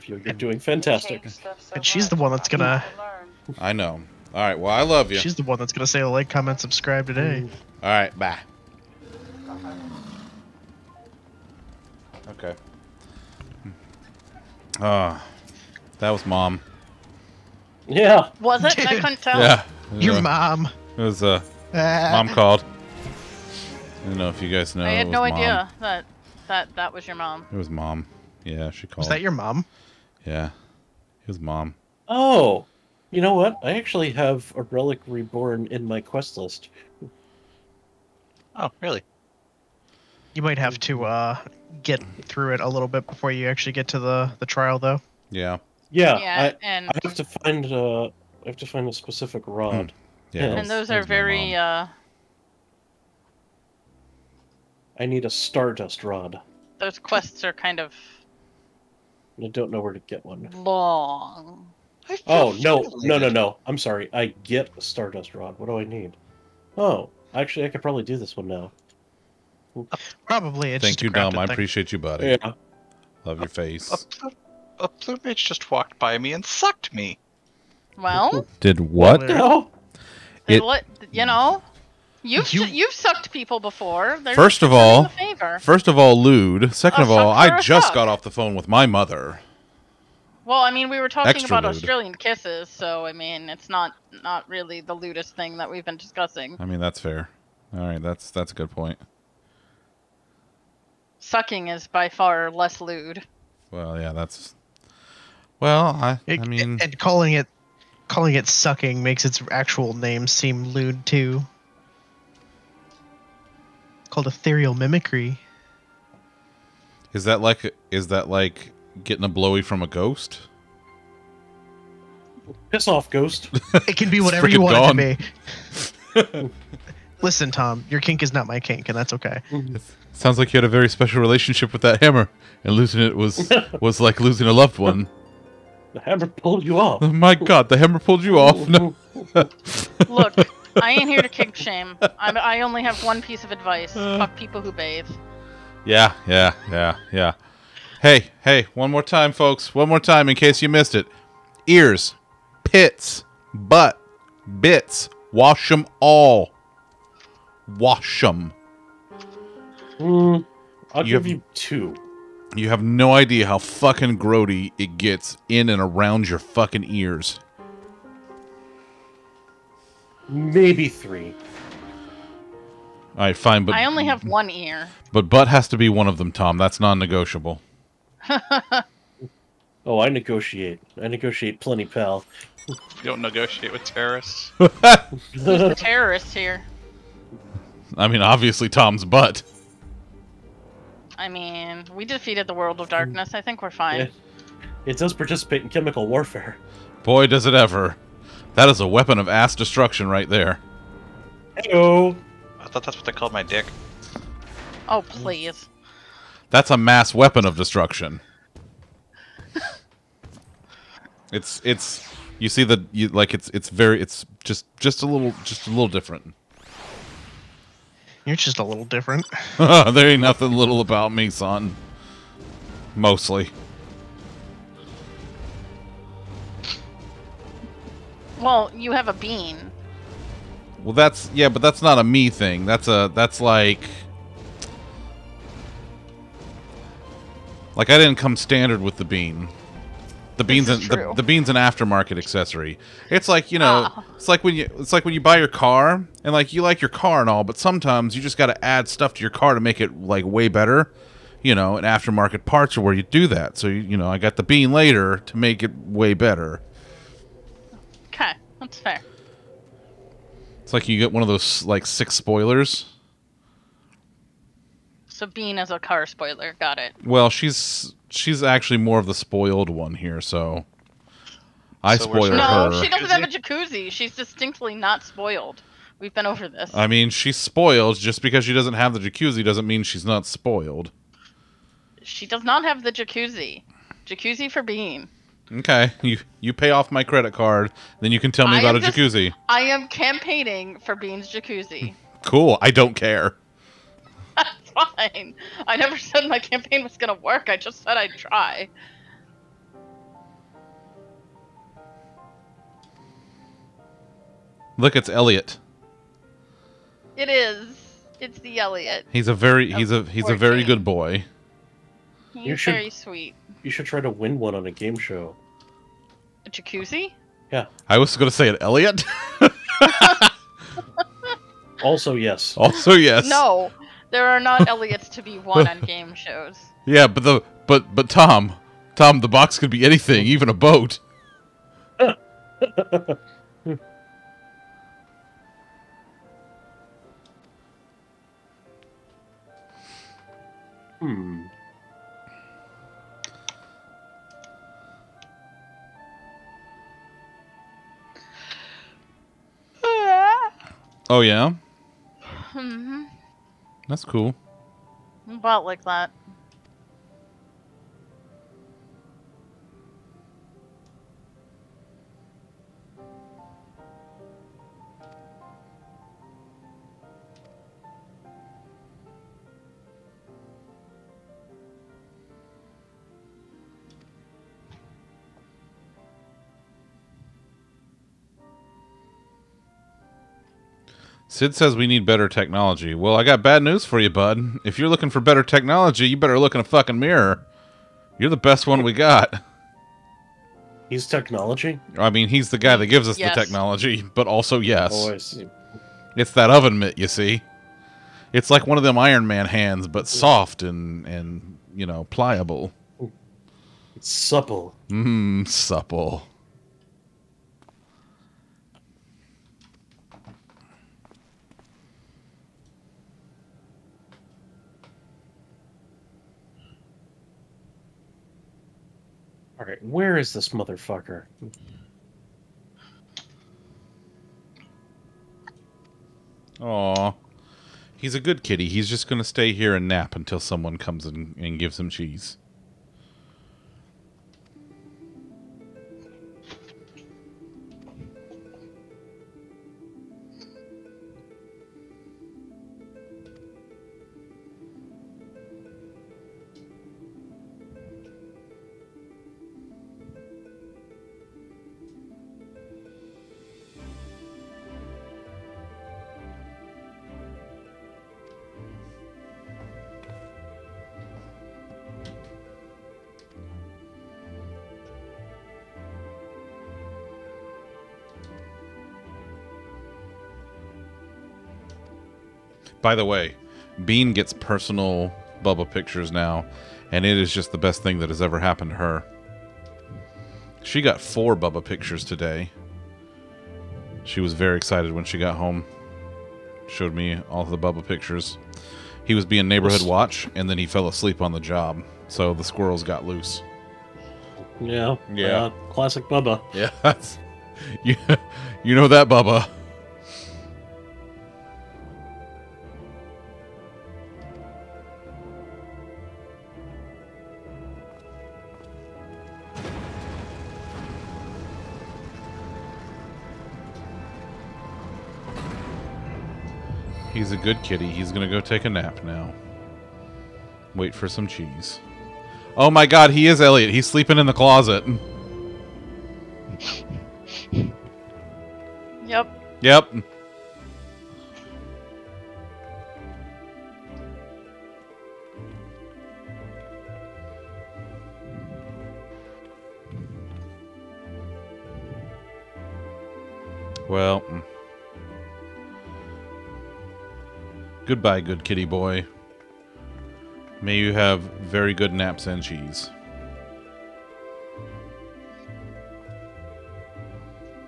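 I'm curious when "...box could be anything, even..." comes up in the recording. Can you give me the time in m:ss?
5:29.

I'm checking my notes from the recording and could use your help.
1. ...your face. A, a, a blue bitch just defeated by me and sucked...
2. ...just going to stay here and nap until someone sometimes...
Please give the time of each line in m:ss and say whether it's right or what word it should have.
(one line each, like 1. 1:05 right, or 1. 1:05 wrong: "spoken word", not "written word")
1. 1:13 wrong: "walked", not "defeated"
2. 7:08 wrong: "comes", not "sometimes".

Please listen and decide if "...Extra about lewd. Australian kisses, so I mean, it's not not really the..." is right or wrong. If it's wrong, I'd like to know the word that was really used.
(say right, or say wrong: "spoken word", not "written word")
right.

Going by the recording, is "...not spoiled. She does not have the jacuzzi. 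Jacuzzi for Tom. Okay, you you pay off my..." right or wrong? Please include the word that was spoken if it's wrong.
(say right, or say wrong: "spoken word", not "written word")
wrong: "Beam", not "Tom".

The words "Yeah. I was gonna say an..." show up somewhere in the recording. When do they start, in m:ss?
5:17.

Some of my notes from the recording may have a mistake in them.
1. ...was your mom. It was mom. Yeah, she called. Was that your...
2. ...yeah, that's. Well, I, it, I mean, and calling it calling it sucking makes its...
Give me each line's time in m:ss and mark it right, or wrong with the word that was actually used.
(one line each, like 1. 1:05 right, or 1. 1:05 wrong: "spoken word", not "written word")
1. 0:26 right
2. 1:43 right.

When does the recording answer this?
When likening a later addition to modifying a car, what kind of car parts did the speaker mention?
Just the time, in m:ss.
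4:11.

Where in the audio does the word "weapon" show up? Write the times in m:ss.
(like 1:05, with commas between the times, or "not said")
3:18, 3:27.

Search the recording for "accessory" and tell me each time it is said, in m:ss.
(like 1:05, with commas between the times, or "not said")
4:02.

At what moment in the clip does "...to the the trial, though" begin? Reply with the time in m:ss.
0:43.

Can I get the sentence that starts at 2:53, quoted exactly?
All right, fine, but I only have mm-hmm.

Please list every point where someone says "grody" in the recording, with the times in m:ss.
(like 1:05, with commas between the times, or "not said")
2:44.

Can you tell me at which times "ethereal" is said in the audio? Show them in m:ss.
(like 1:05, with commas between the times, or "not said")
1:54.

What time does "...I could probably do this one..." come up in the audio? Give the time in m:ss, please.
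1:07.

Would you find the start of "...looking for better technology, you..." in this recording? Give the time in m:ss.
6:24.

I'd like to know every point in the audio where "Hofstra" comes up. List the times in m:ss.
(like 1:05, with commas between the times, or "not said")
not said.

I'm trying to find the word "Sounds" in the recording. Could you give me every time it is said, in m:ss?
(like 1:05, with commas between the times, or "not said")
2:10.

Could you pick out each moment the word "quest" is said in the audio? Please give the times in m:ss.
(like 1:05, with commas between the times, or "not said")
0:36, 0:56.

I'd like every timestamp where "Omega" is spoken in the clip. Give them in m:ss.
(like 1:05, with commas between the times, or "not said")
not said.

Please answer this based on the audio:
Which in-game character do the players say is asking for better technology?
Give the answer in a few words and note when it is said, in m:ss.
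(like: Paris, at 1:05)
Cid, at 6:21.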